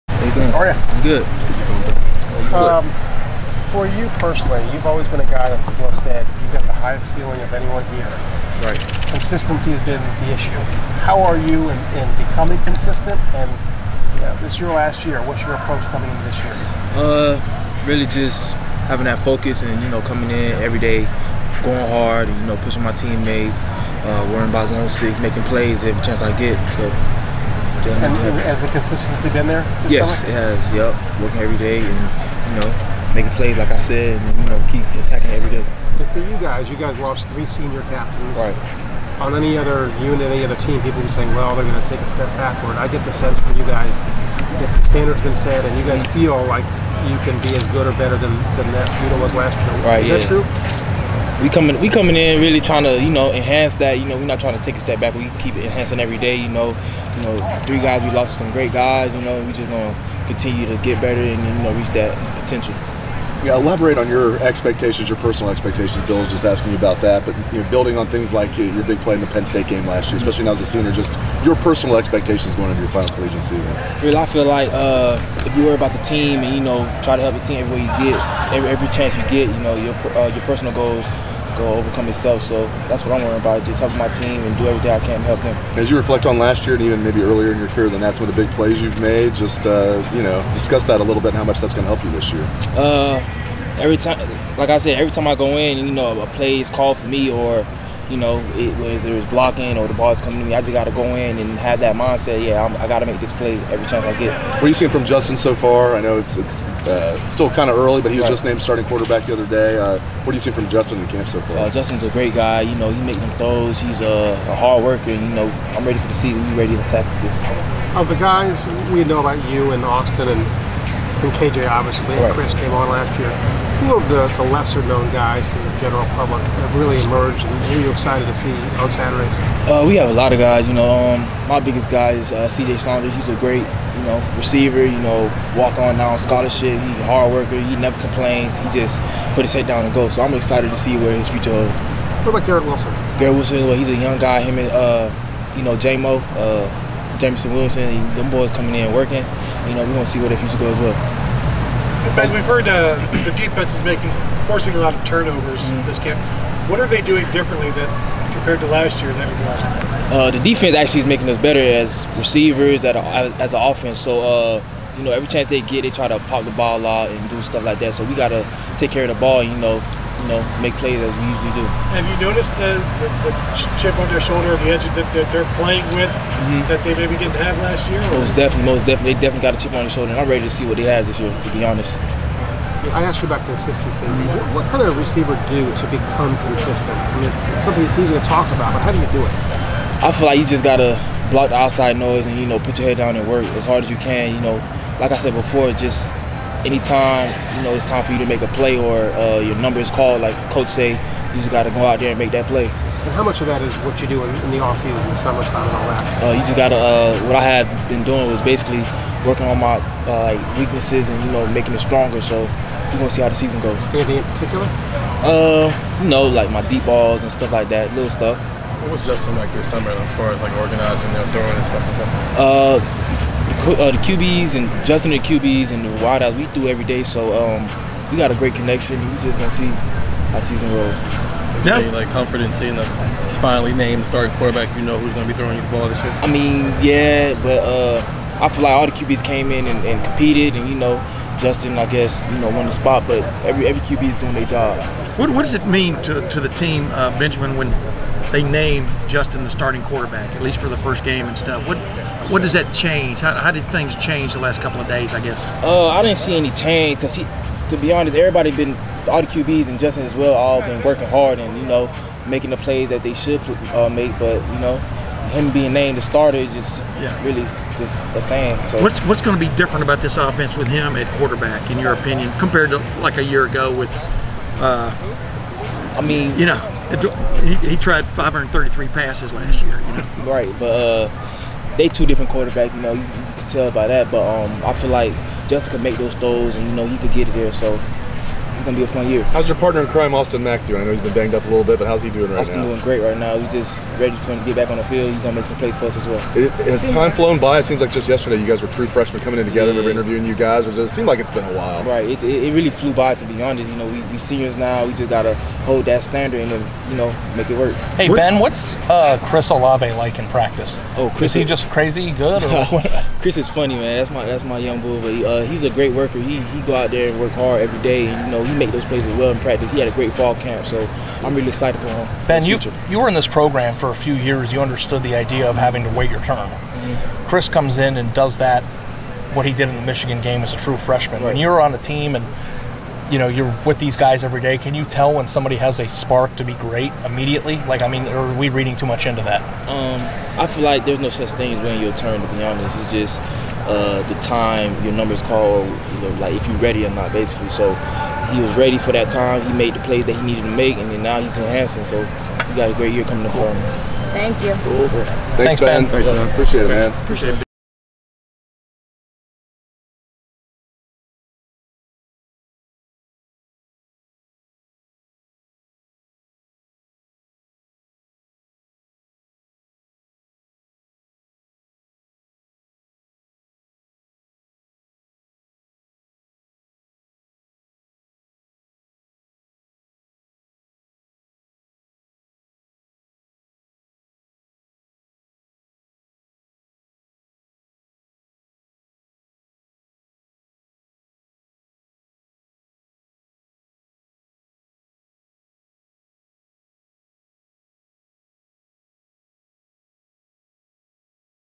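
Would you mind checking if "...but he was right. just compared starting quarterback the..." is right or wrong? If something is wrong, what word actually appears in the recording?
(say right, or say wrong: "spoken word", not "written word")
wrong: "named", not "compared".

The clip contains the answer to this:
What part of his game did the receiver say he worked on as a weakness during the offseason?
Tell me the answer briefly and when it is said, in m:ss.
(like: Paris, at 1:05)
Deep balls, at 3:36.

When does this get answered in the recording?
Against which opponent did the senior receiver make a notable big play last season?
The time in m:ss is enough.
1:09.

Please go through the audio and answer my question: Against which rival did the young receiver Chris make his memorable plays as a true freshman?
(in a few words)
Michigan.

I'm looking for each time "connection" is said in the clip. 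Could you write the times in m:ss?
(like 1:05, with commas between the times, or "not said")
3:48.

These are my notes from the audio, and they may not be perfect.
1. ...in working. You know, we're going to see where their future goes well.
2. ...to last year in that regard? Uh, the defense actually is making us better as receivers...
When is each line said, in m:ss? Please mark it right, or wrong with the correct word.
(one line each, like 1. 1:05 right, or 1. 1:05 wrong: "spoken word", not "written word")
1. 2:28 right
2. 2:38 right.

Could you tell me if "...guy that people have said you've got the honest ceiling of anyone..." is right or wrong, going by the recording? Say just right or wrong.
wrong.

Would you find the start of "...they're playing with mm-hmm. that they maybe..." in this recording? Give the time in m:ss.
2:55.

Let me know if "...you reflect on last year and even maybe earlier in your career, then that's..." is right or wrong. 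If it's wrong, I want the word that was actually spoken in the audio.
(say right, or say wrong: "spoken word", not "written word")
right.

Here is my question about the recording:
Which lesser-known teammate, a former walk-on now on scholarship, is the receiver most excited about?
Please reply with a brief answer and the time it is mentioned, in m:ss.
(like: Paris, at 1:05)
CJ Saunders, at 2:12.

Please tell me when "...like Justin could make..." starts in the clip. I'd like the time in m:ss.
4:44.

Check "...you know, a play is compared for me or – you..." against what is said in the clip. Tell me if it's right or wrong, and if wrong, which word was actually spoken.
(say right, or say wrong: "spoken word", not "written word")
wrong: "called", not "compared".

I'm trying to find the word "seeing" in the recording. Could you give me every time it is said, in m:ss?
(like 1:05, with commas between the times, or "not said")
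1:44, 1:50, 3:52.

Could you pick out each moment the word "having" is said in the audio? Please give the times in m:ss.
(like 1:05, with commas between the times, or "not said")
0:18, 5:25.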